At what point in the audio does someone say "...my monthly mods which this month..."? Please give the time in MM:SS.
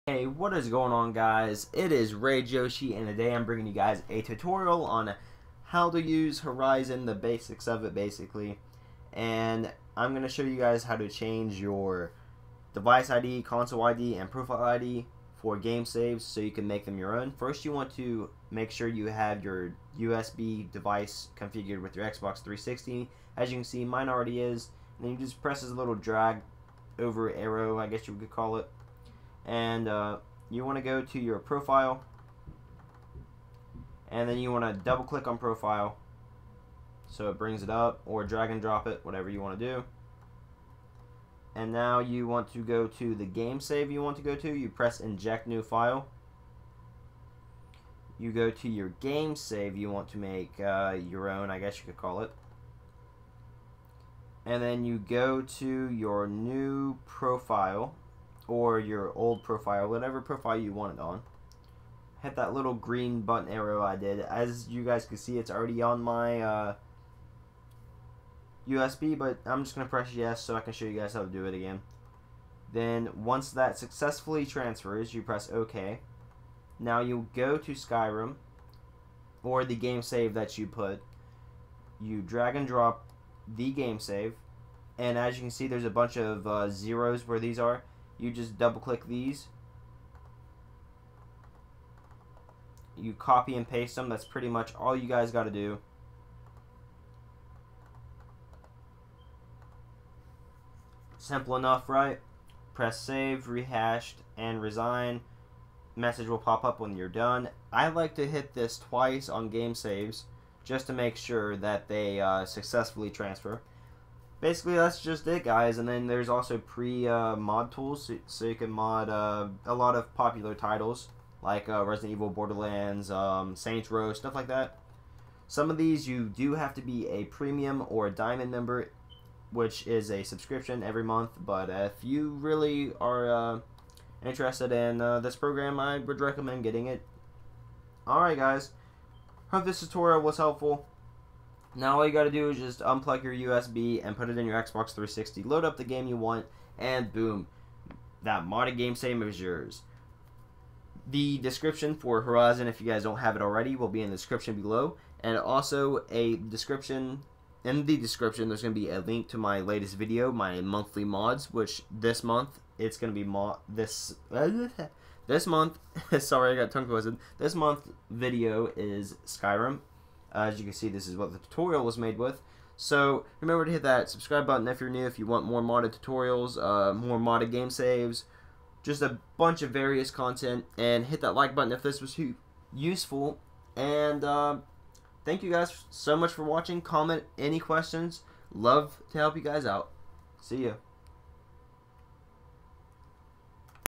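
02:40.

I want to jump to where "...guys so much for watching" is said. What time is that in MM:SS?
03:05.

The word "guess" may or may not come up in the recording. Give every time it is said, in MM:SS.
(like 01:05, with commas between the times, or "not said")
00:27, 00:51.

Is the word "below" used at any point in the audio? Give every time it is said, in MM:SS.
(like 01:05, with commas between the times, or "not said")
02:34.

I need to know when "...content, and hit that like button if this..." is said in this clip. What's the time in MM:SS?
03:00.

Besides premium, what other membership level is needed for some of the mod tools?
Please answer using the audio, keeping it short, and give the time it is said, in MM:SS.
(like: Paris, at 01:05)
diamond, at 02:08.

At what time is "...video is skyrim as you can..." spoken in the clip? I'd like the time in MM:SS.
02:48.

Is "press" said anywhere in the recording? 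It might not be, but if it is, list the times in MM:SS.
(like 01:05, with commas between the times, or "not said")
00:25, 00:44, 01:09, 01:15, 01:42.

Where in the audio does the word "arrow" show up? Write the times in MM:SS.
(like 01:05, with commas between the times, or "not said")
00:27, 01:03.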